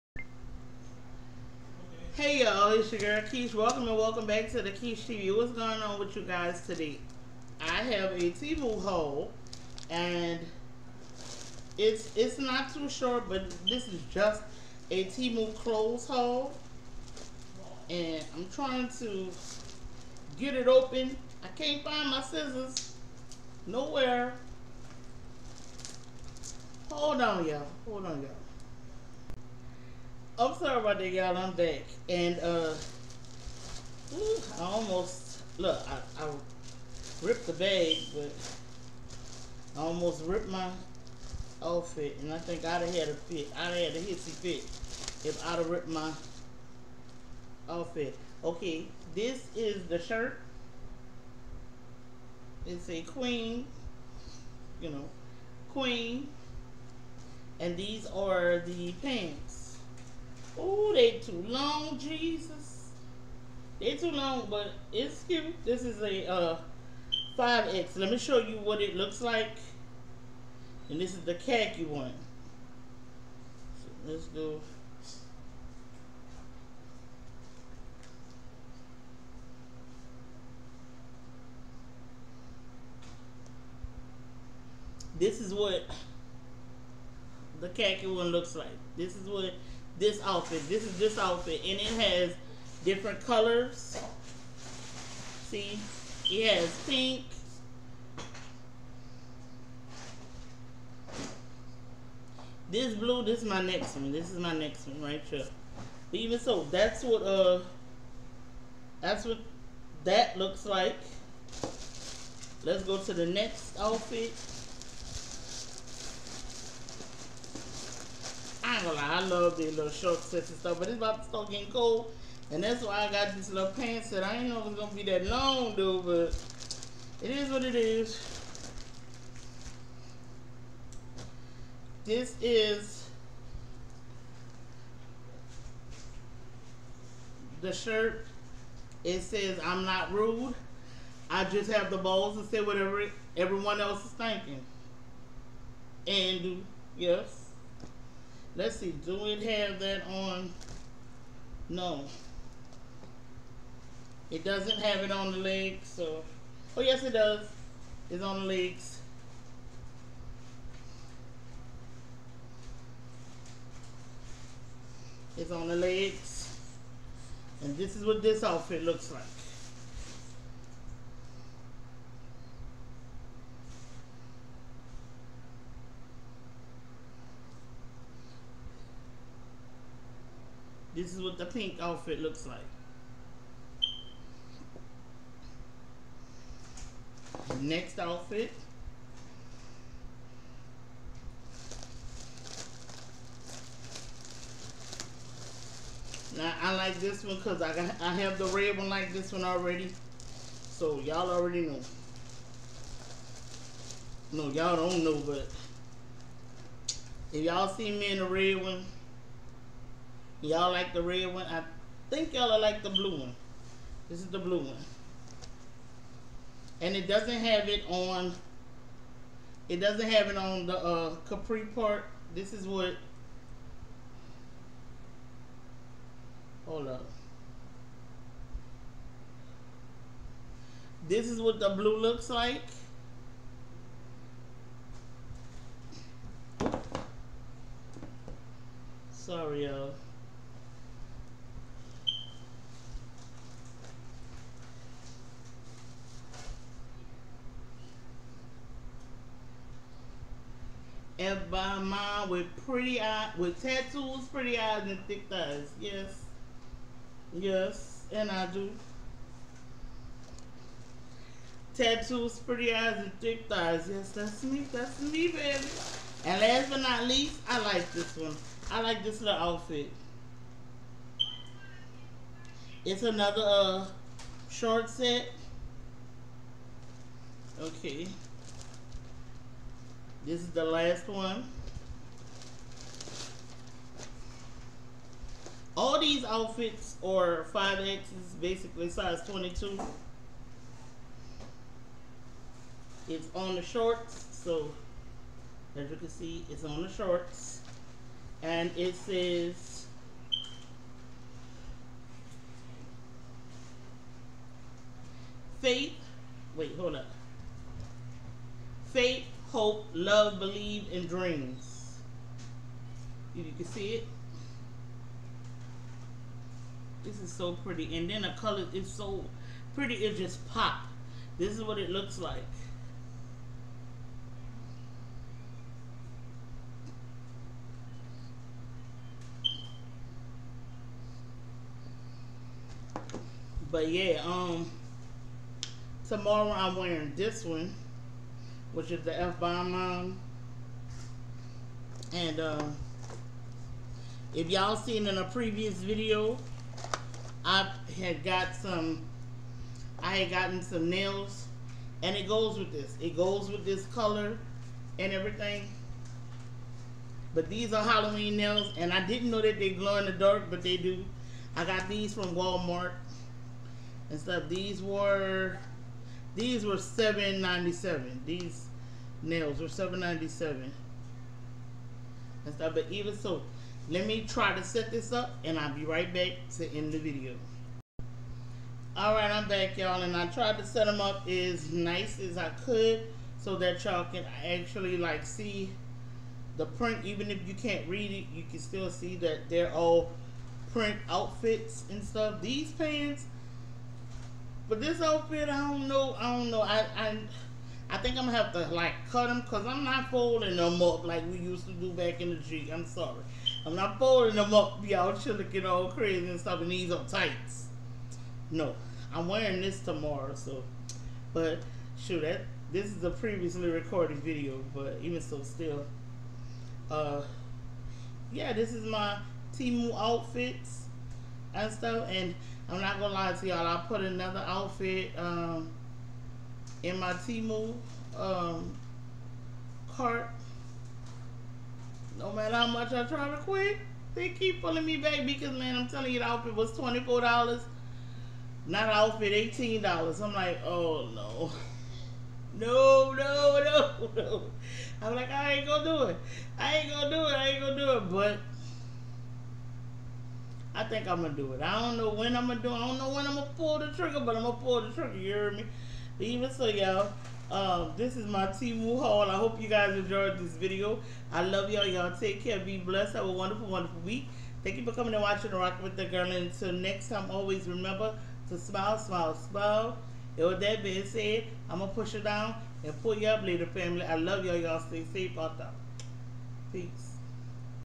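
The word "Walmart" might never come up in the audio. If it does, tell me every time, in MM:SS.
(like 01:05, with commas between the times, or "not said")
06:02.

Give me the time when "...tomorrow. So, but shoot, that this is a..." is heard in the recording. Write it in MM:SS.
06:49.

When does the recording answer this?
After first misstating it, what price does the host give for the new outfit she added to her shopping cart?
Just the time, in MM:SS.
07:19.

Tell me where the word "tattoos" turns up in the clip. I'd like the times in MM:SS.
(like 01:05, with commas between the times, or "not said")
04:13, 04:21.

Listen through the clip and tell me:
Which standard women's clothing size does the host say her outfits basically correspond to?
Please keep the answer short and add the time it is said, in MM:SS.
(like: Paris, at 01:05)
22, at 04:48.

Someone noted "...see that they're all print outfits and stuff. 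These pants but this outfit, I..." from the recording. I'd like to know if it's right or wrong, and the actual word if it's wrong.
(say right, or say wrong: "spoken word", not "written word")
right.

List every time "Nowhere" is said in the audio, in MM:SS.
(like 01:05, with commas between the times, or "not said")
00:23.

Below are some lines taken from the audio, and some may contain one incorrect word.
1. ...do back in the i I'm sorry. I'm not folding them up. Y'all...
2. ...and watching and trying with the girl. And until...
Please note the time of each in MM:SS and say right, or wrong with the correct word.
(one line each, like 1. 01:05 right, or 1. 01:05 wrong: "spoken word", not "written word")
1. 06:41 right
2. 07:45 wrong: "rocking", not "trying".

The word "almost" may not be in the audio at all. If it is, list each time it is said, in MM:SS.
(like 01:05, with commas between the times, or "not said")
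00:34, 00:39.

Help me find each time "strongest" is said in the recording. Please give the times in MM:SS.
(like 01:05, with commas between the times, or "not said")
not said.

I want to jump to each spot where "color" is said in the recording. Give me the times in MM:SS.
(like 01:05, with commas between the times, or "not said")
01:33, 05:18, 05:53.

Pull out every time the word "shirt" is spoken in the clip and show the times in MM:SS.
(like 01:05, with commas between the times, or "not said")
00:49, 02:17.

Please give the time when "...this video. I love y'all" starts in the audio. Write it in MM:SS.
07:40.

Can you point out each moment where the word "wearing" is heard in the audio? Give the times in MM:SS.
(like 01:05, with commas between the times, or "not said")
05:36, 06:49.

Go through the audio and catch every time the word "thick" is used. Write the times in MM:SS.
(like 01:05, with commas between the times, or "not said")
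04:15, 04:23.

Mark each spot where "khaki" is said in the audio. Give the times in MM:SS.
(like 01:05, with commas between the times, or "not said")
01:11, 01:27.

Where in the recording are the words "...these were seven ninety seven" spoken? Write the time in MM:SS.
06:06.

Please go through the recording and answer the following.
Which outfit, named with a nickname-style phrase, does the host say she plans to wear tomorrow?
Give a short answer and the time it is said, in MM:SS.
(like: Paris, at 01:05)
F bomb mom, at 05:39.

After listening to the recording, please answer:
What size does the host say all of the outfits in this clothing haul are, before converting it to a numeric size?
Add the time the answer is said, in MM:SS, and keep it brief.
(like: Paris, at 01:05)
5X, at 04:47.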